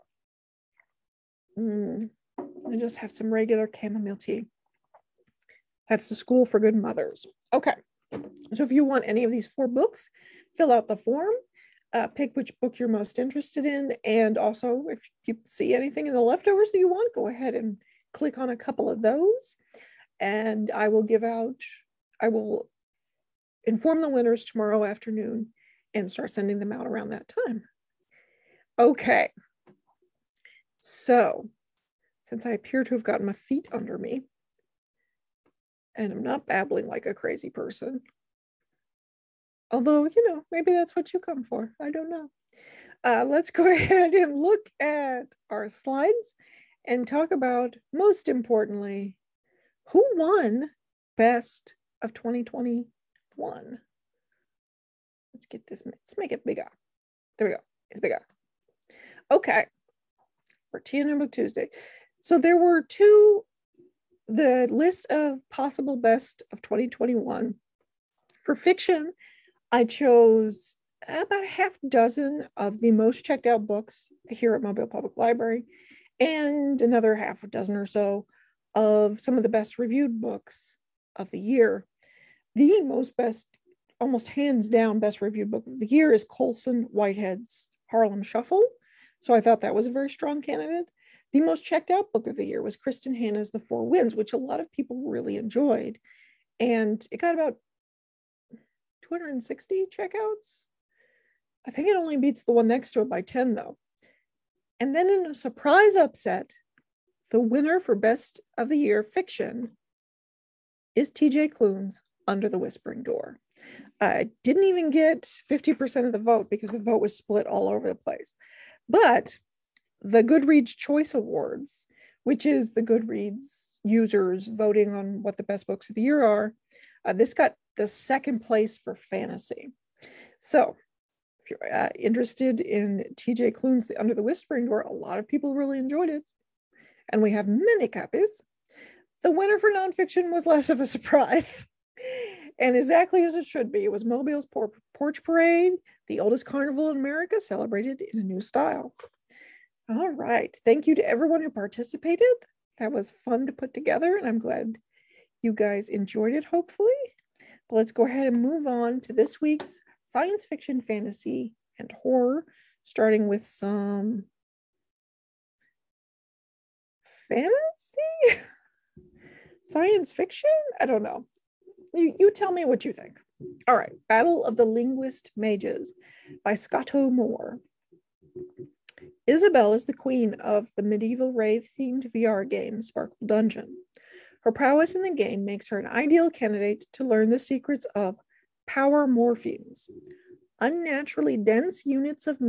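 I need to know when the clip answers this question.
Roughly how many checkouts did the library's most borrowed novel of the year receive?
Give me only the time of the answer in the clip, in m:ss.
1:39.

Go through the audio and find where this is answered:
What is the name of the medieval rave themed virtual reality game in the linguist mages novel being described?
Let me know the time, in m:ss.
3:02.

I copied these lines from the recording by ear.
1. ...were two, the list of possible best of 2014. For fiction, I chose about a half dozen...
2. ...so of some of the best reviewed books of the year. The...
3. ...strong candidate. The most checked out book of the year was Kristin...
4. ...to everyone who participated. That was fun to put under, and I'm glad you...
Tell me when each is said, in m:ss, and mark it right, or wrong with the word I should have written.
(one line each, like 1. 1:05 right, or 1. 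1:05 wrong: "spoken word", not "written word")
1. 1:02 wrong: "2021", not "2014"
2. 1:17 right
3. 1:30 right
4. 2:30 wrong: "together", not "under".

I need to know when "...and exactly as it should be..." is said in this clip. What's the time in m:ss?
2:22.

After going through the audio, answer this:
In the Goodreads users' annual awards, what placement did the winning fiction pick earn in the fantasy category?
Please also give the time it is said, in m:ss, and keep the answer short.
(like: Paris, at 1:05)
Second place, at 2:07.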